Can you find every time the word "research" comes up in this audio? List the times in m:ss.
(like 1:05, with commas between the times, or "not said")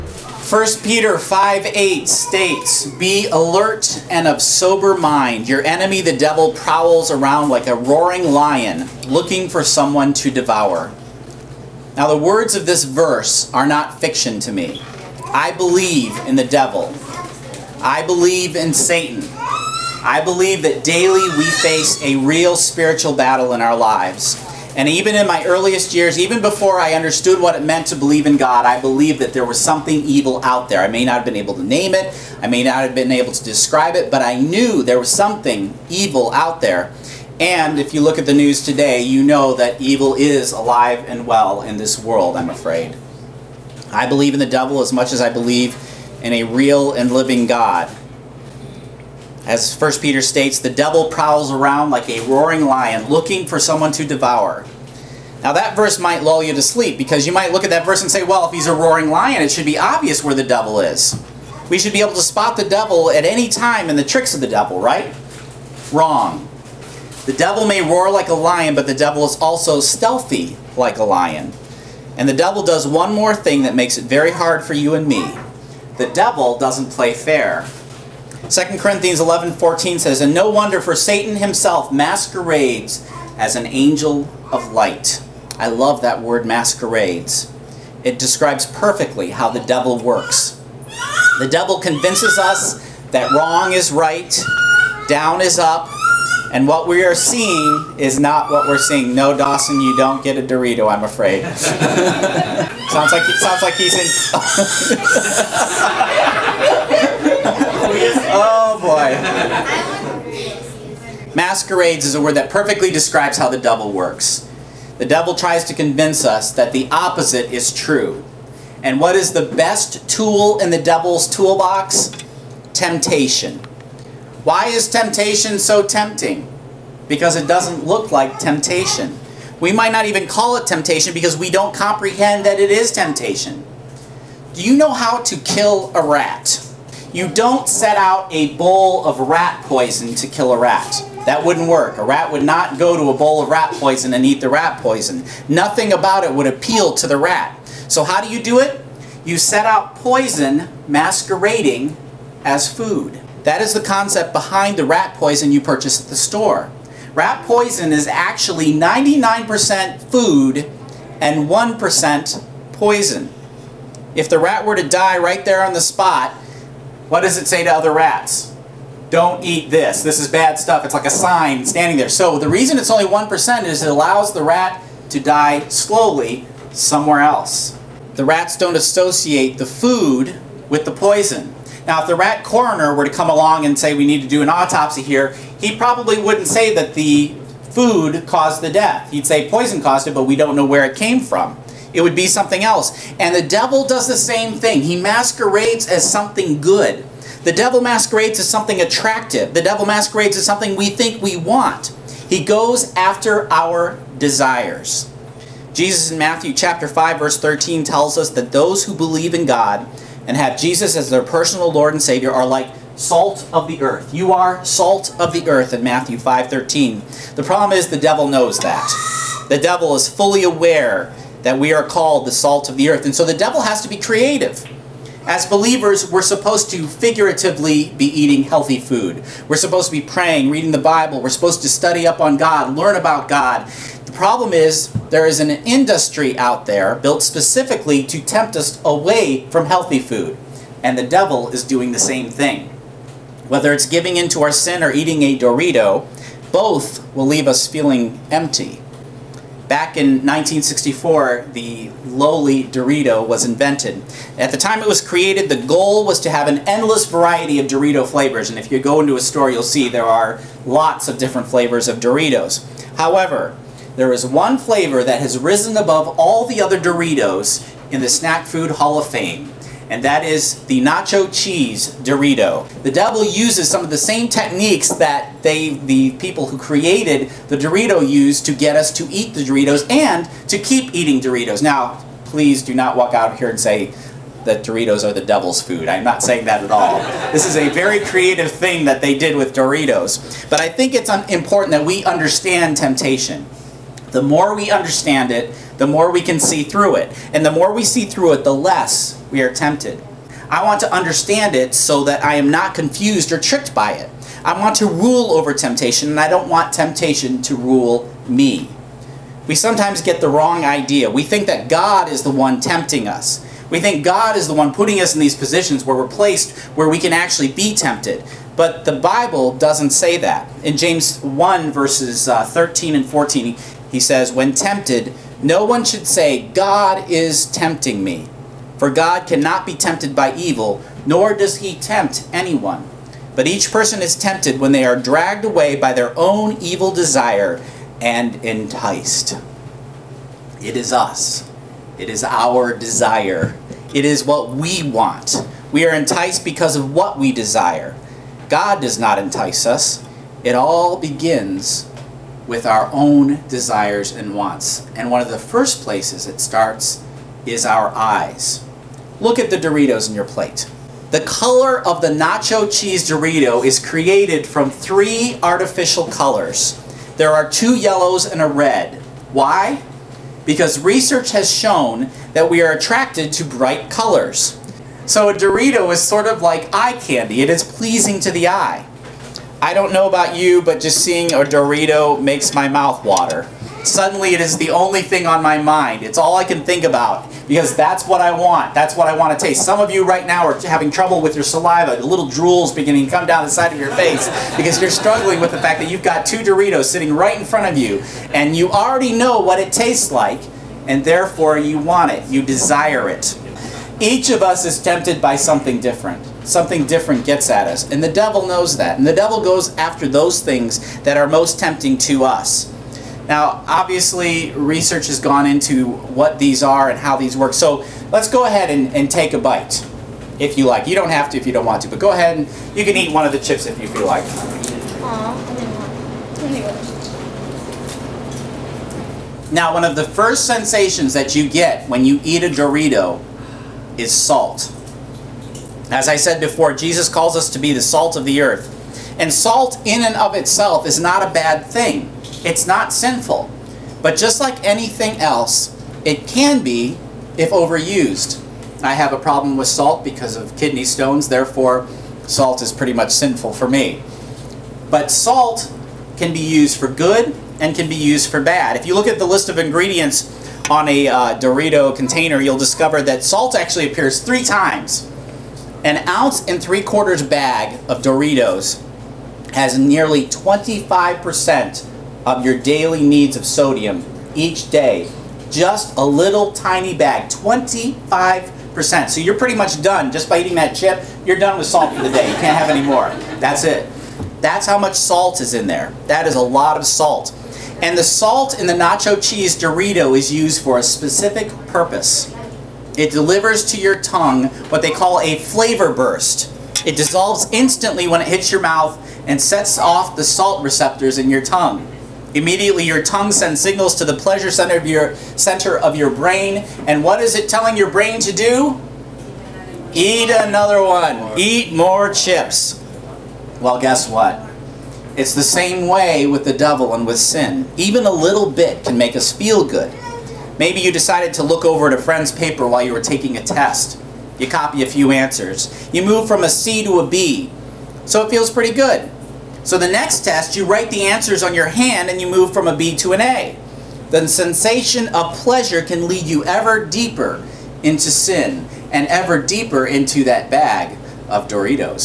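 6:10, 6:54.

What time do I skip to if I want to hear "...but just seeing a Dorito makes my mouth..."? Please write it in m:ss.
6:20.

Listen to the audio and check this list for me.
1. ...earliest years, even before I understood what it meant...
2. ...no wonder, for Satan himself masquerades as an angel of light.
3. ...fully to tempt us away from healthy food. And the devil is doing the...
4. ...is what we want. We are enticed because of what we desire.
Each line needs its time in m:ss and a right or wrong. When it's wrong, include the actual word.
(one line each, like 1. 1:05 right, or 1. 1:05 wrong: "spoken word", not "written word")
1. 0:25 right
2. 1:20 right
3. 3:57 wrong: "specifically", not "fully"
4. 5:44 right.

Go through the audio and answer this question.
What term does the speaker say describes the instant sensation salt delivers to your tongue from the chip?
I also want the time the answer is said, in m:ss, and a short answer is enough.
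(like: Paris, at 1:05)
flavor burst, at 8:15.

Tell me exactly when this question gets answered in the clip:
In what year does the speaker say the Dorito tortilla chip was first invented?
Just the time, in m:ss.
4:10.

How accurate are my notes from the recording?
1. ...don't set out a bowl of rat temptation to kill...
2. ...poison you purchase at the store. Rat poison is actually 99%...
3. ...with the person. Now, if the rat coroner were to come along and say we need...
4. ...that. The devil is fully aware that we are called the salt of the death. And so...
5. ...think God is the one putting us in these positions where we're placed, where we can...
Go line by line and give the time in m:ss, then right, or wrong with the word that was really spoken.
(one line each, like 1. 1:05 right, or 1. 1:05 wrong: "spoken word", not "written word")
1. 2:17 wrong: "poison", not "temptation"
2. 2:35 right
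3. 3:00 wrong: "poison", not "person"
4. 3:38 wrong: "earth", not "death"
5. 5:13 right.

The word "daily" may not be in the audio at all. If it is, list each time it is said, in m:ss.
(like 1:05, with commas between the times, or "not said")
0:20, 7:52.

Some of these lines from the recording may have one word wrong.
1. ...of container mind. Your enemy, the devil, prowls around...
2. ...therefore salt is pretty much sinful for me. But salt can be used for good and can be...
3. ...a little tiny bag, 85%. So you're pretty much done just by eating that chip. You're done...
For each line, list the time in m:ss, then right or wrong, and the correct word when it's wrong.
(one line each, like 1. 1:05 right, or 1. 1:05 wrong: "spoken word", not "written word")
1. 0:04 wrong: "sober", not "container"
2. 7:31 right
3. 7:55 wrong: "25", not "85".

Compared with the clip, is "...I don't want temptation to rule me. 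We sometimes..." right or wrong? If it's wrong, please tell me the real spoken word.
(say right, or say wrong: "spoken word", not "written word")
right.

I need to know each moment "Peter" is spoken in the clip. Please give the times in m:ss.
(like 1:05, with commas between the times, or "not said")
0:00, 0:49.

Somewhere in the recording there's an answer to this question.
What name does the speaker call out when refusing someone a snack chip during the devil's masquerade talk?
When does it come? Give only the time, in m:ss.
1:39.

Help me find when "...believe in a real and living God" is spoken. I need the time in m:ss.
0:45.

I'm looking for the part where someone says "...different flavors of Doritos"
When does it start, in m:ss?
4:21.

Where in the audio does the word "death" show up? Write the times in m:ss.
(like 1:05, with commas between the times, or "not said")
3:08.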